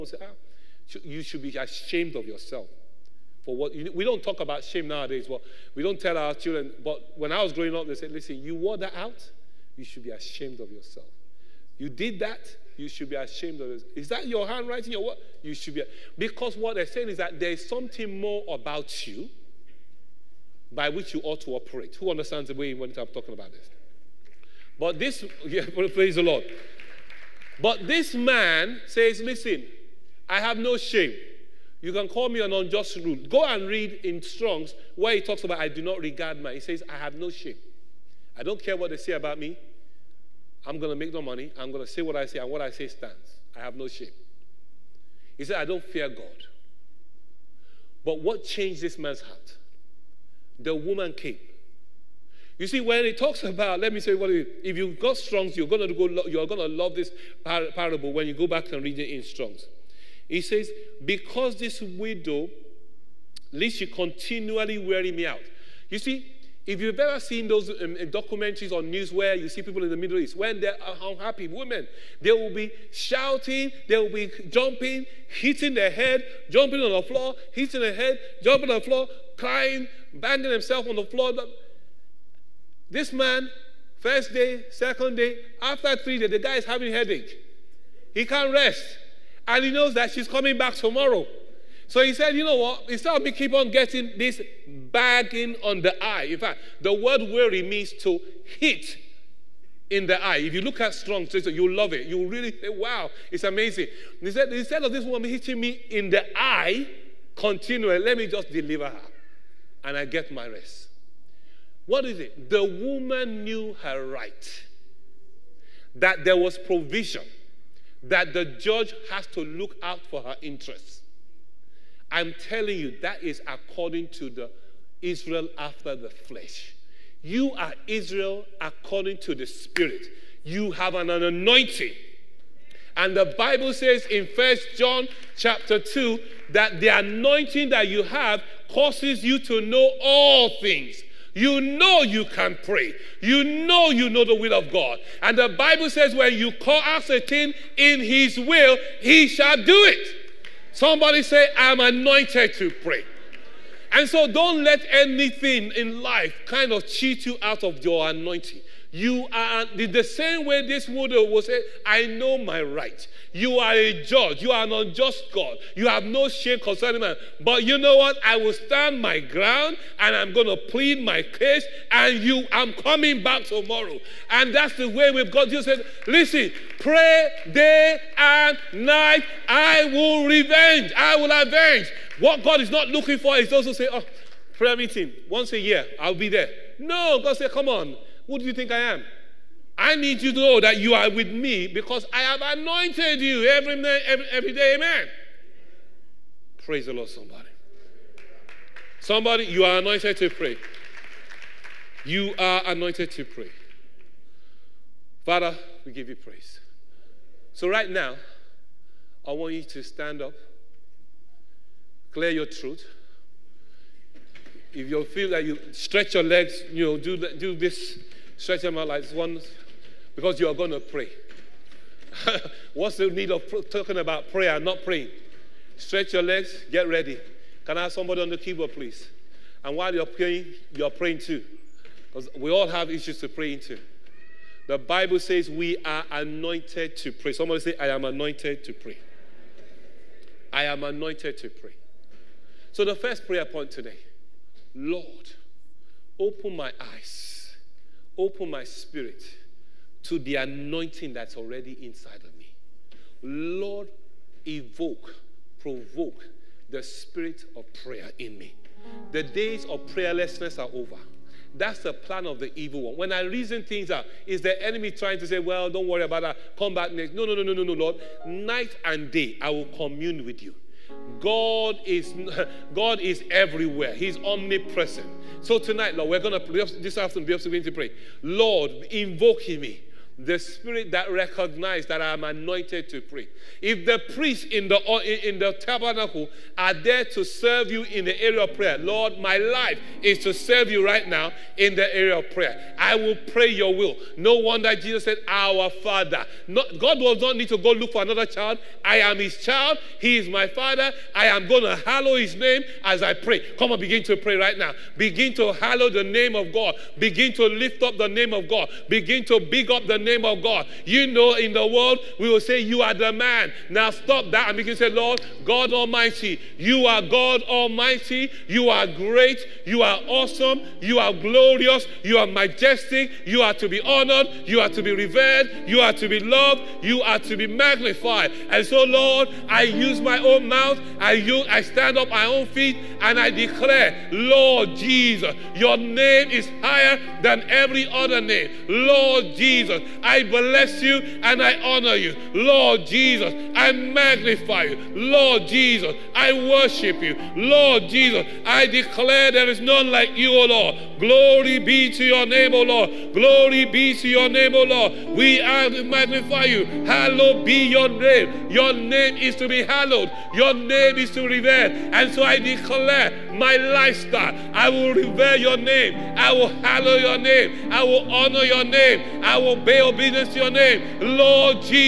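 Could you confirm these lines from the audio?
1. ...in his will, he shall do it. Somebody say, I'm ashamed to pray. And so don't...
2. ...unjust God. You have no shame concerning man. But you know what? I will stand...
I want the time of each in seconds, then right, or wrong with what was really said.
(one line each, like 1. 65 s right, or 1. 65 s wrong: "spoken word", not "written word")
1. 147 s wrong: "anointed", not "ashamed"
2. 164 s right.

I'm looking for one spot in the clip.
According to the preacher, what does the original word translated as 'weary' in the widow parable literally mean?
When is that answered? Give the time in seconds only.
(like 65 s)
98 s.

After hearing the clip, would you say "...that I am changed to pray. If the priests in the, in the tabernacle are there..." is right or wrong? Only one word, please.
wrong.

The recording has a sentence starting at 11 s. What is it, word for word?
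You did that, you should be ashamed of yourself.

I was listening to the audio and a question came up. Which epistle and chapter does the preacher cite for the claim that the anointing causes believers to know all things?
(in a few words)
First John chapter 2.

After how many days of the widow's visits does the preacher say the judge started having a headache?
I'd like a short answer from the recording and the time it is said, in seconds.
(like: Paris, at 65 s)
3, at 86 s.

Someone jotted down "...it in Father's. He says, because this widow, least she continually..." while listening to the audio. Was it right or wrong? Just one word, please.
wrong.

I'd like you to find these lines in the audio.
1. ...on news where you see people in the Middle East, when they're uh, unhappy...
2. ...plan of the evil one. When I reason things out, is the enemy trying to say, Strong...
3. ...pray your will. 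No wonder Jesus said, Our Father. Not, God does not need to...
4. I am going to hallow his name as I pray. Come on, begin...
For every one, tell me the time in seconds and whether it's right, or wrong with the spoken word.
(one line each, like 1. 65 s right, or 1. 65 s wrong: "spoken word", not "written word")
1. 68 s right
2. 261 s wrong: "Well", not "Strong"
3. 293 s right
4. 301 s right.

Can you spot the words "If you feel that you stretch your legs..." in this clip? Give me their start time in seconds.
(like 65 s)
214 s.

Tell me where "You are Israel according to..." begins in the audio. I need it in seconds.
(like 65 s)
127 s.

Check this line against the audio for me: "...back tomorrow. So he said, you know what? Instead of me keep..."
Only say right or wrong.
right.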